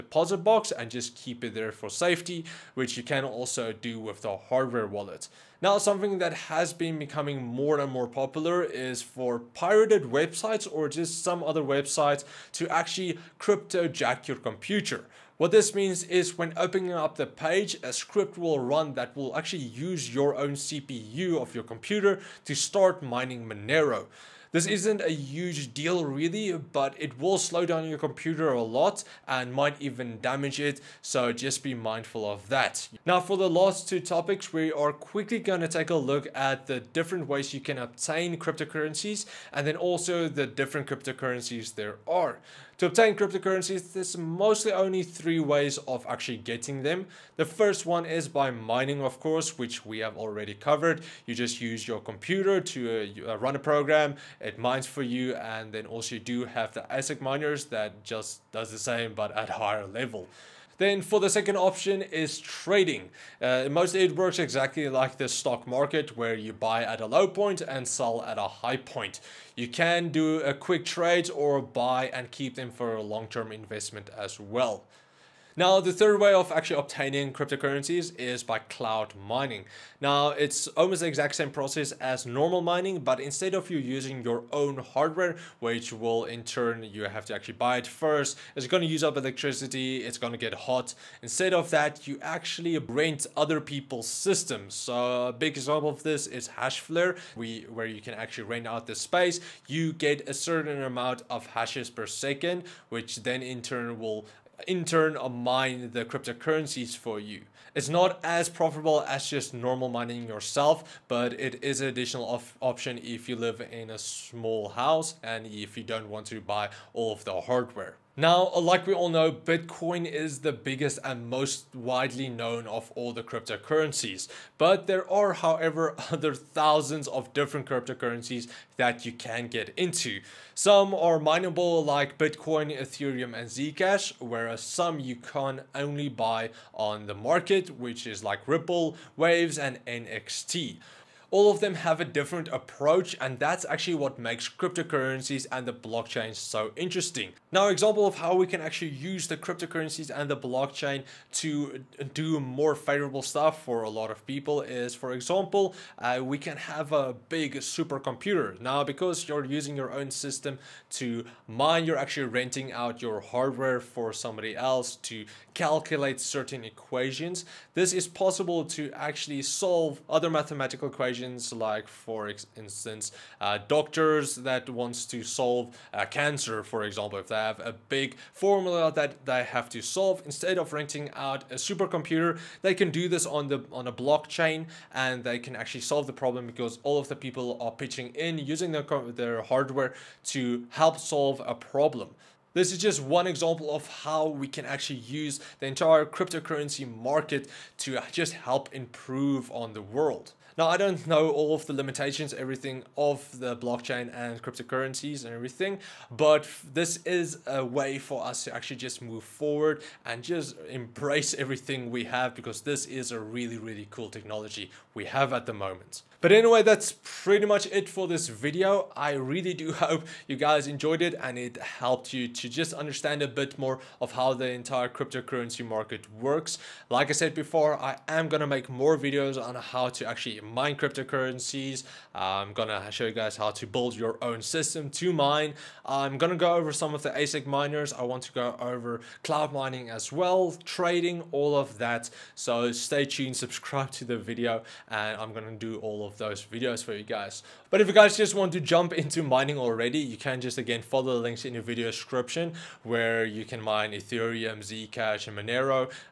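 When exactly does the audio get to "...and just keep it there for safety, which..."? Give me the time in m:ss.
0:00.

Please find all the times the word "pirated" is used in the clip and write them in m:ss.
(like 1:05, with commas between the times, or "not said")
0:09.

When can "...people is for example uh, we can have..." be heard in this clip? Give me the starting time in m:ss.
2:34.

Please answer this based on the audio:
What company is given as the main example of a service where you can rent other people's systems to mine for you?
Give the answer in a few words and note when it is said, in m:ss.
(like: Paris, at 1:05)
Hashflare, at 1:36.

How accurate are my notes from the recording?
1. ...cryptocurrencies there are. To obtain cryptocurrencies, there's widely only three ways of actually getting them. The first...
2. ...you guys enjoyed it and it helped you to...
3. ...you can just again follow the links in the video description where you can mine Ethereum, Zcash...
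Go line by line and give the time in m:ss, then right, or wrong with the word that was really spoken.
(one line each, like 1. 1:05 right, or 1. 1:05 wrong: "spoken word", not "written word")
1. 0:40 wrong: "mostly", not "widely"
2. 3:40 right
3. 4:09 right.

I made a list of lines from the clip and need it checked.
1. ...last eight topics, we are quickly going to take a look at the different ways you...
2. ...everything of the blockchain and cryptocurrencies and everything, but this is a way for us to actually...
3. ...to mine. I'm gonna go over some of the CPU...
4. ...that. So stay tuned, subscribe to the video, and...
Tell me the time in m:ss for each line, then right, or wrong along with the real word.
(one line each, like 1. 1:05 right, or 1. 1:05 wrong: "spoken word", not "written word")
1. 0:33 wrong: "two", not "eight"
2. 3:22 right
3. 3:54 wrong: "ASIC", not "CPU"
4. 4:01 right.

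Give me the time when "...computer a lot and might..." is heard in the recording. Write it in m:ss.
0:27.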